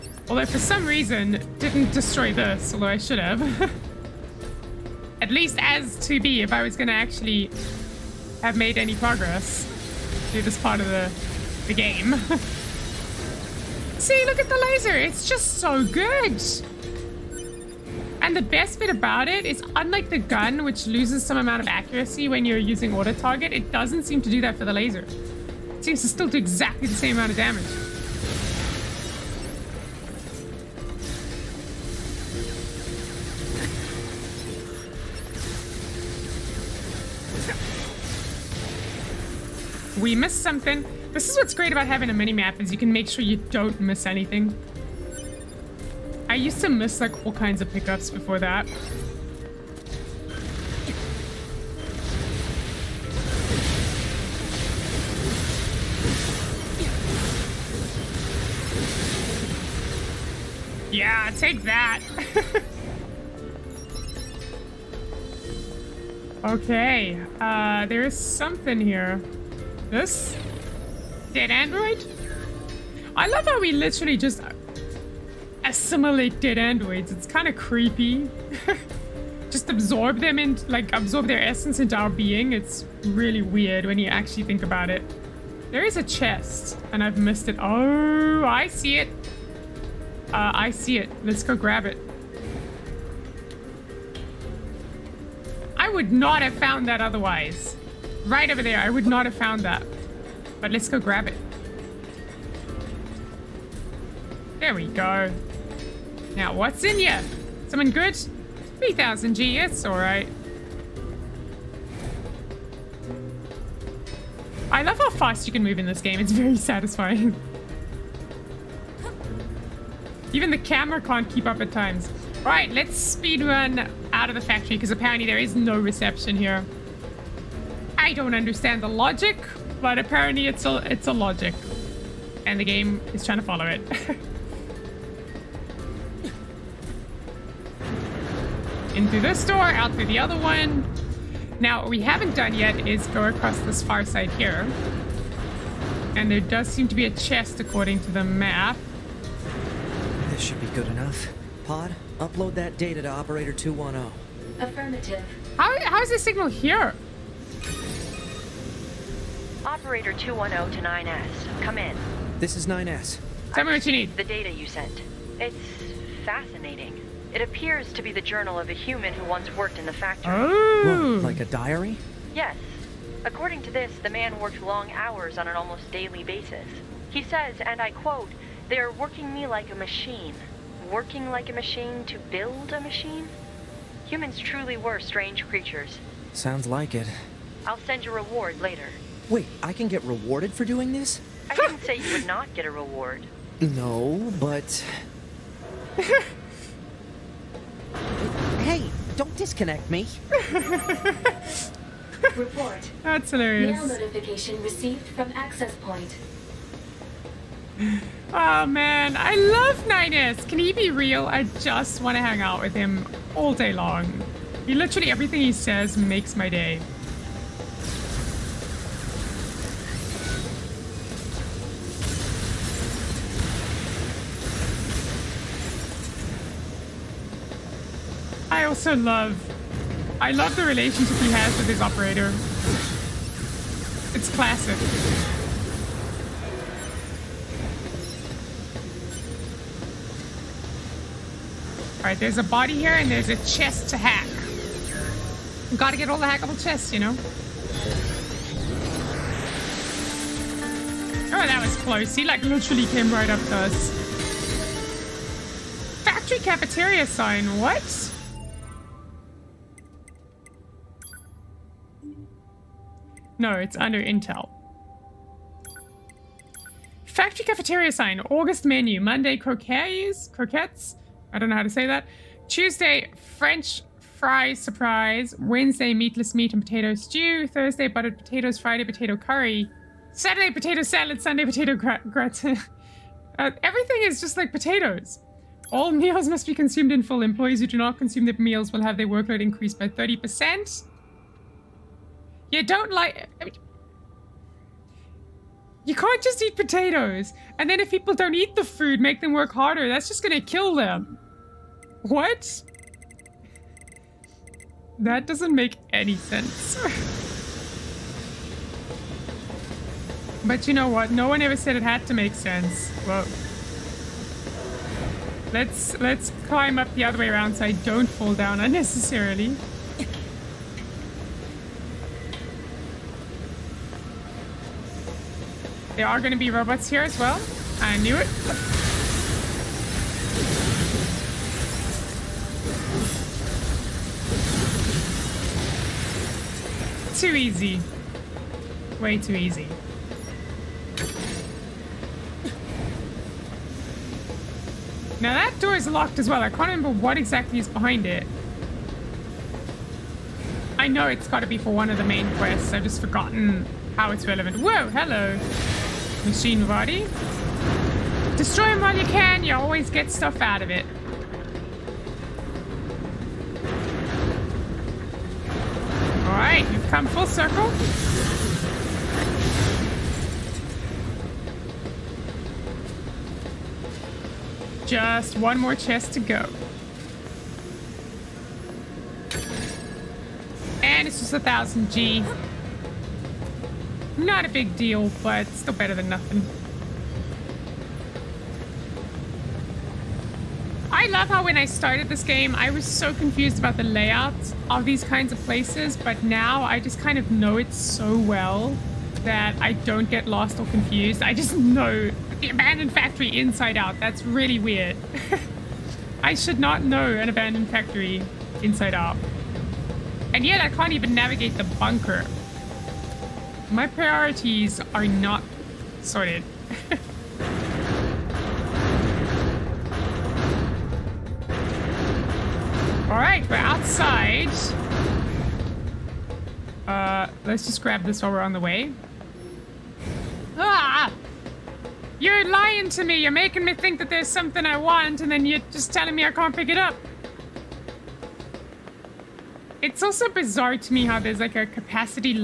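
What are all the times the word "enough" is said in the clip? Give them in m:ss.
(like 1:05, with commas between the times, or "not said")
2:30.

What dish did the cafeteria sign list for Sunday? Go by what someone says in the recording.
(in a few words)
Potato gratin.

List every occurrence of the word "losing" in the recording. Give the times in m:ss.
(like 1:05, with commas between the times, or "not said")
not said.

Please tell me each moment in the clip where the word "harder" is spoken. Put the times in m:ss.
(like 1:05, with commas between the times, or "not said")
4:59.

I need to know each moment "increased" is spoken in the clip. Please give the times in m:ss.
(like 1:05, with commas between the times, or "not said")
4:49.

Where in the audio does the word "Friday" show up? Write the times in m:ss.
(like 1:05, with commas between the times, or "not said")
4:38.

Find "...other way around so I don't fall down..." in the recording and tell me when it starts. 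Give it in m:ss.
5:17.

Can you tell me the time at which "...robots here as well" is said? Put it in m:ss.
5:26.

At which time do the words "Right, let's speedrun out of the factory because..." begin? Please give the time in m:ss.
2:02.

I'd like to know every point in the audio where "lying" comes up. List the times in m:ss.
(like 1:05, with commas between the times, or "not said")
7:12.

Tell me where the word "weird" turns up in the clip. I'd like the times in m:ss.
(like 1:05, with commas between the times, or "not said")
1:23, 6:44.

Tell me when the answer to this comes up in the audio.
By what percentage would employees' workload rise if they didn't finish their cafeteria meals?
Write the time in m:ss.
4:49.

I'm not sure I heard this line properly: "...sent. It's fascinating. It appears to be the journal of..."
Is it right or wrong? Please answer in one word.
right.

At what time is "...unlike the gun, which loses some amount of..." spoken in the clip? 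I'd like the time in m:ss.
0:19.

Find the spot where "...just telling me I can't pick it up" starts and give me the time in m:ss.
7:15.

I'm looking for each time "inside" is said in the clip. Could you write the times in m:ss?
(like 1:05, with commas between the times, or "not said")
6:43, 6:48.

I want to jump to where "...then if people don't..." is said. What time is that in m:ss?
4:57.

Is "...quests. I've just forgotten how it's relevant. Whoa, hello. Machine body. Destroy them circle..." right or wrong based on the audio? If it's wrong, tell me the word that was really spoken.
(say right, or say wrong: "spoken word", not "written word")
wrong: "while", not "circle".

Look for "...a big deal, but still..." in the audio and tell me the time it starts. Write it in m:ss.
6:24.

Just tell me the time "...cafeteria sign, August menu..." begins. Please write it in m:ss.
4:27.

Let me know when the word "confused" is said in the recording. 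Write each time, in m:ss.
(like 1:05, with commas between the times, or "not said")
6:33, 6:40.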